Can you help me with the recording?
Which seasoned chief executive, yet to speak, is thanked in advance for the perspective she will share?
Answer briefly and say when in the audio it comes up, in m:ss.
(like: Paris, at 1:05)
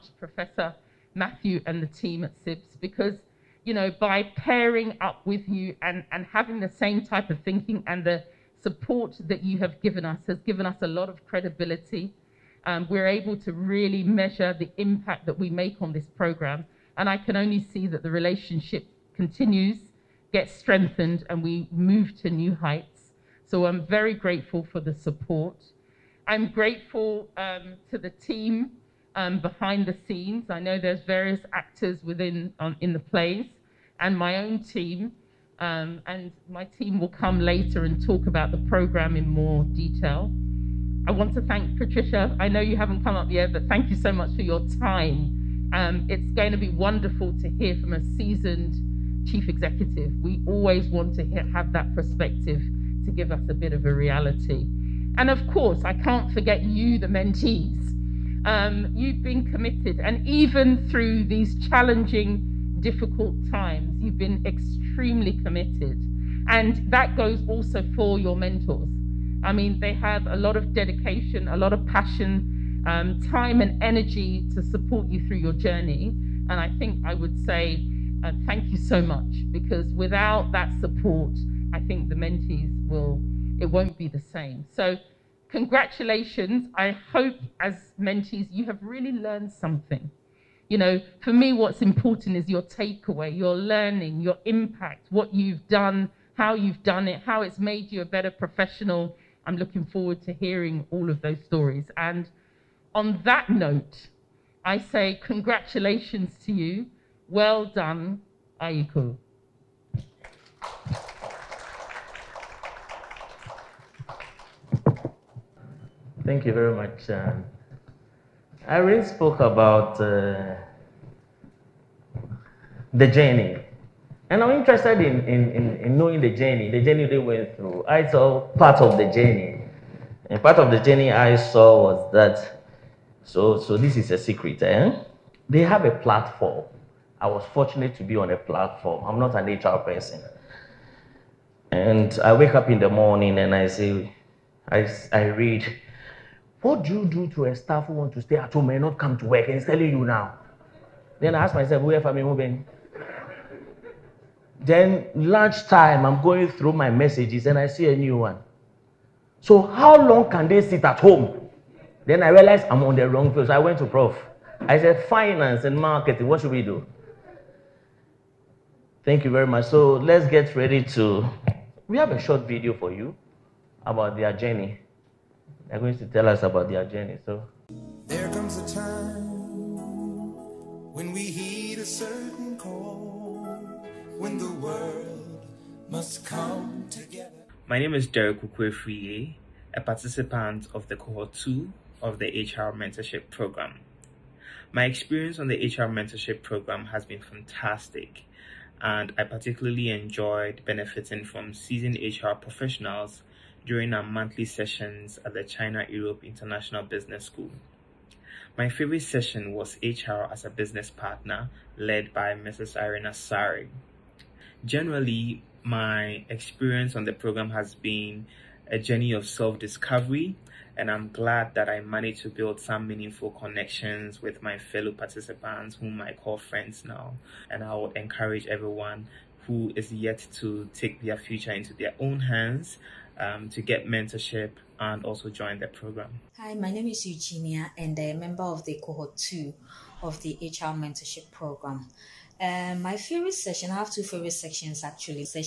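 Patricia, at 0:41.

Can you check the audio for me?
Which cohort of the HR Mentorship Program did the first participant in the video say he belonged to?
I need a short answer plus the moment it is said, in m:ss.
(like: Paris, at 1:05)
Cohort 2, at 3:10.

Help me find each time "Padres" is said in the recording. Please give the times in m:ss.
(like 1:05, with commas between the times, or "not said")
not said.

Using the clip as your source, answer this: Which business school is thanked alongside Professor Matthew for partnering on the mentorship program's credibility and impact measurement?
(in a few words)
CEIBS.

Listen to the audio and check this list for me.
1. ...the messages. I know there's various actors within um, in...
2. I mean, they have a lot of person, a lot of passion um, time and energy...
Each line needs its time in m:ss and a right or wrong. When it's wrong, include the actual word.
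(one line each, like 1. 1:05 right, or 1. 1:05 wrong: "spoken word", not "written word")
1. 0:29 wrong: "scenes", not "messages"
2. 1:09 wrong: "dedication", not "person".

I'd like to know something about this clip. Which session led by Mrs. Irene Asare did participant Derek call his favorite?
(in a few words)
HR as a business partner.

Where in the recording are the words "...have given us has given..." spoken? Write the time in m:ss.
0:09.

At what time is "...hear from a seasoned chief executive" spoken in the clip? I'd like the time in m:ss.
0:47.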